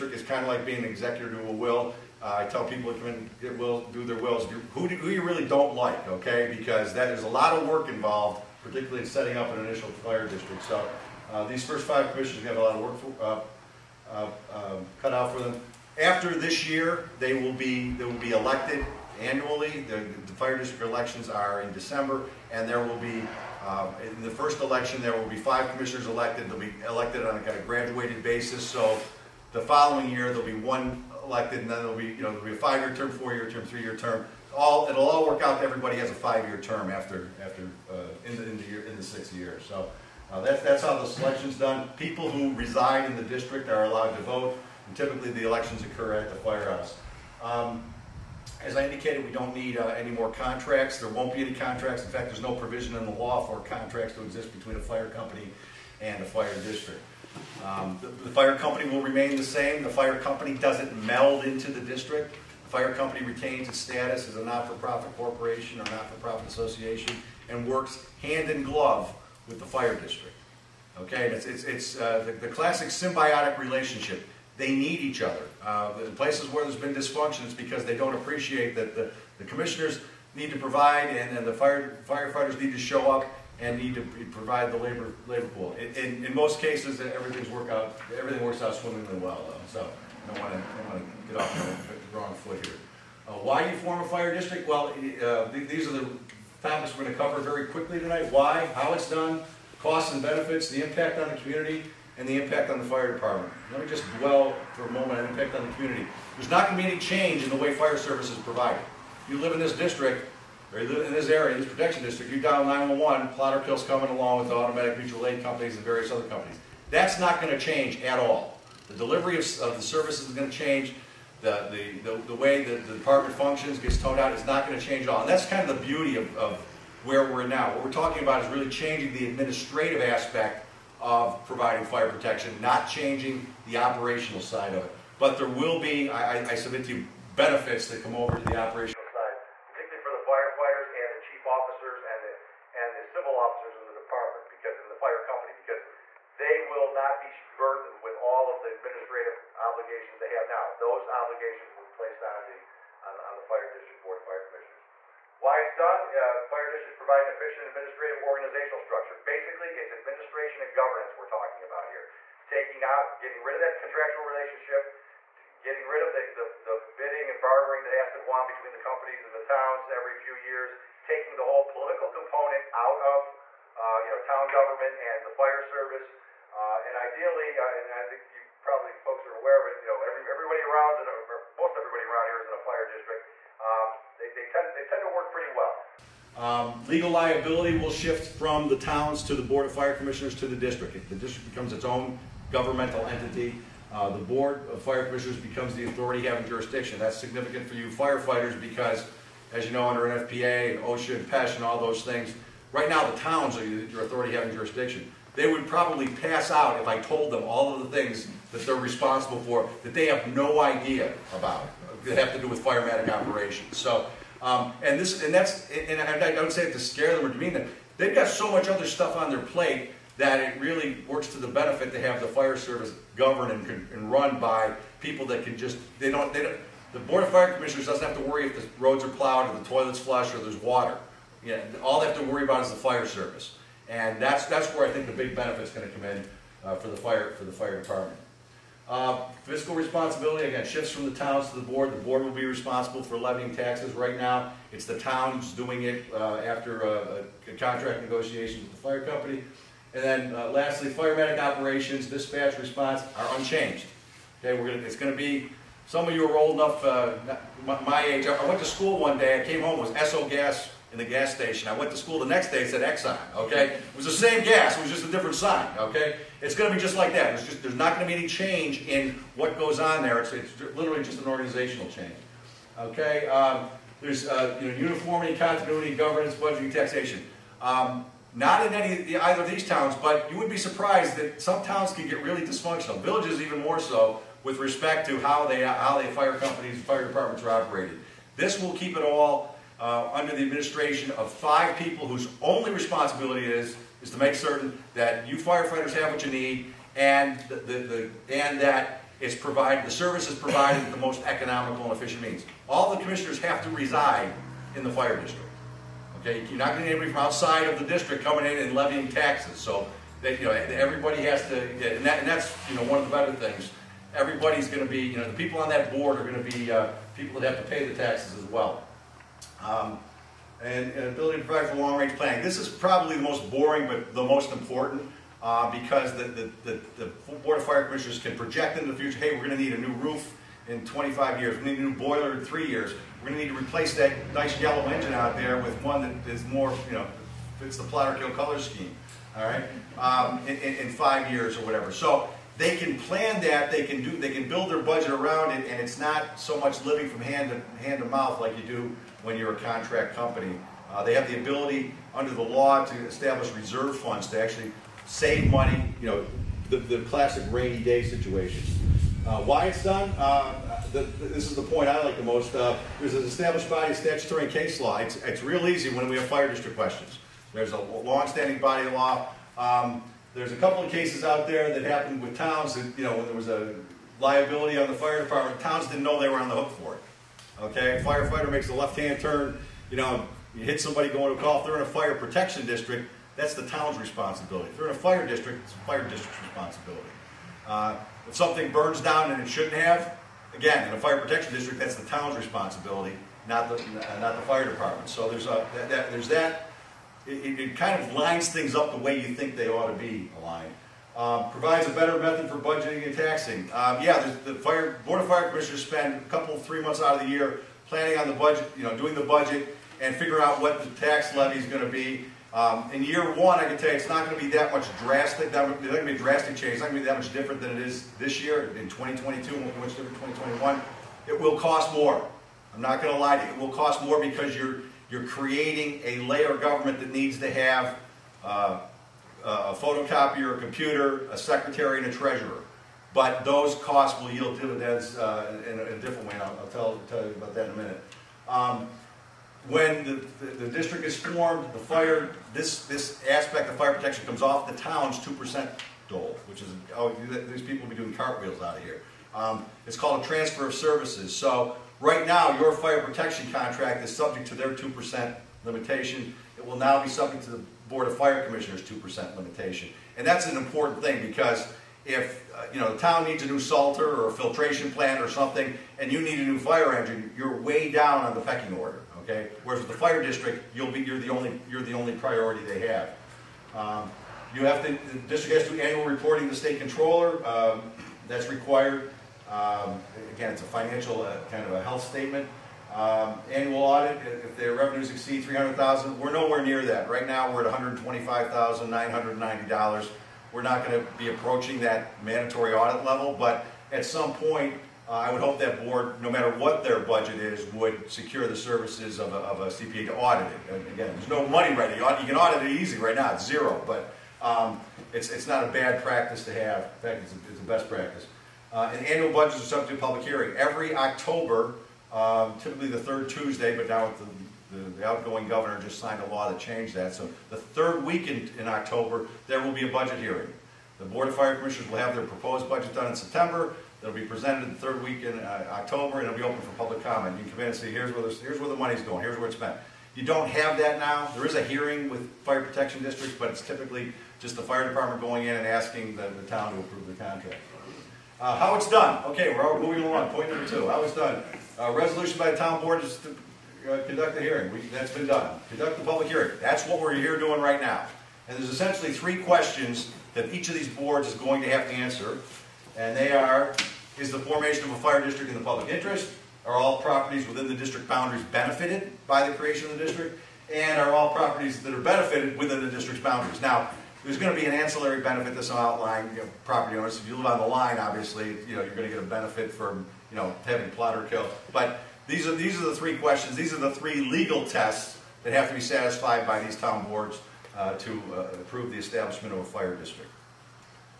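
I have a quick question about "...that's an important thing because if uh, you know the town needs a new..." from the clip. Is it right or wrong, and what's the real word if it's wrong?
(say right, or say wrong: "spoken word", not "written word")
right.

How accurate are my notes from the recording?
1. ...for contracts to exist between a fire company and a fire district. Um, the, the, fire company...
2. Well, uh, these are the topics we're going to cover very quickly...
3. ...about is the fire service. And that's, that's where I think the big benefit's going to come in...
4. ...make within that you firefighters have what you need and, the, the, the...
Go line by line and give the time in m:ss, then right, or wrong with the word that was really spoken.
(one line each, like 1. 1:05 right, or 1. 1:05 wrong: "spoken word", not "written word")
1. 0:53 right
2. 1:34 right
3. 3:52 right
4. 4:54 wrong: "certain", not "within".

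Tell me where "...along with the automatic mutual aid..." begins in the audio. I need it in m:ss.
1:54.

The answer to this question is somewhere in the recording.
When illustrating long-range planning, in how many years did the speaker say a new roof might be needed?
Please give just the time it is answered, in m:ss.
5:30.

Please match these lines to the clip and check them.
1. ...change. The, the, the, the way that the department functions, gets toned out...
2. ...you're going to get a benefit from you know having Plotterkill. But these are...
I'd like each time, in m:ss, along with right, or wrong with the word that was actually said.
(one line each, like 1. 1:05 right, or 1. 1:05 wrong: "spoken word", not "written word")
1. 2:00 right
2. 9:28 right.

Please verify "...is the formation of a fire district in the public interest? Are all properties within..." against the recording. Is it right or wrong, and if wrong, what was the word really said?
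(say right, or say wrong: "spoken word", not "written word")
right.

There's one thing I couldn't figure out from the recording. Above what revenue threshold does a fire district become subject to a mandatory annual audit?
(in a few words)
300000.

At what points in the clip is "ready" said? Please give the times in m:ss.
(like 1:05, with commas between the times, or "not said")
8:21.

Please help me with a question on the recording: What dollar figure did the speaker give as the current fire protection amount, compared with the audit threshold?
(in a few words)
$125,990.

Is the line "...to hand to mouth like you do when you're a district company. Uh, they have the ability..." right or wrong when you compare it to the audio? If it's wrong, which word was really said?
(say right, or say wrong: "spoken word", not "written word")
wrong: "contract", not "district".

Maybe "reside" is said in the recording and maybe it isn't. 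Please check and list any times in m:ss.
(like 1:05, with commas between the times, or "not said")
0:42, 5:03.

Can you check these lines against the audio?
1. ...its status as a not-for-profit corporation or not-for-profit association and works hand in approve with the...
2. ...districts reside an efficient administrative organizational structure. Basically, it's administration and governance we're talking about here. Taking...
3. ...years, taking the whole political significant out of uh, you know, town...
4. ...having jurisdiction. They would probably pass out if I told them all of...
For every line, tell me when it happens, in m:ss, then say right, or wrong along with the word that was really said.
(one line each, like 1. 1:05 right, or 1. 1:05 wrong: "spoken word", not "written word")
1. 1:03 wrong: "glove", not "approve"
2. 2:36 wrong: "provide", not "reside"
3. 2:50 wrong: "component", not "significant"
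4. 3:24 right.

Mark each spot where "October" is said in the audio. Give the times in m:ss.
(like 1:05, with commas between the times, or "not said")
8:30, 8:38, 8:45.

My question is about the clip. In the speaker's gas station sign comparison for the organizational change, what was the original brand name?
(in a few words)
Esso.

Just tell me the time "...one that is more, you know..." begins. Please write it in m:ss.
5:35.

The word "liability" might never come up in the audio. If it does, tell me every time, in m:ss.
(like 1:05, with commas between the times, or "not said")
3:07, 6:14.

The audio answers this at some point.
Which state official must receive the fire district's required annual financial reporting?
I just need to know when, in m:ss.
7:56.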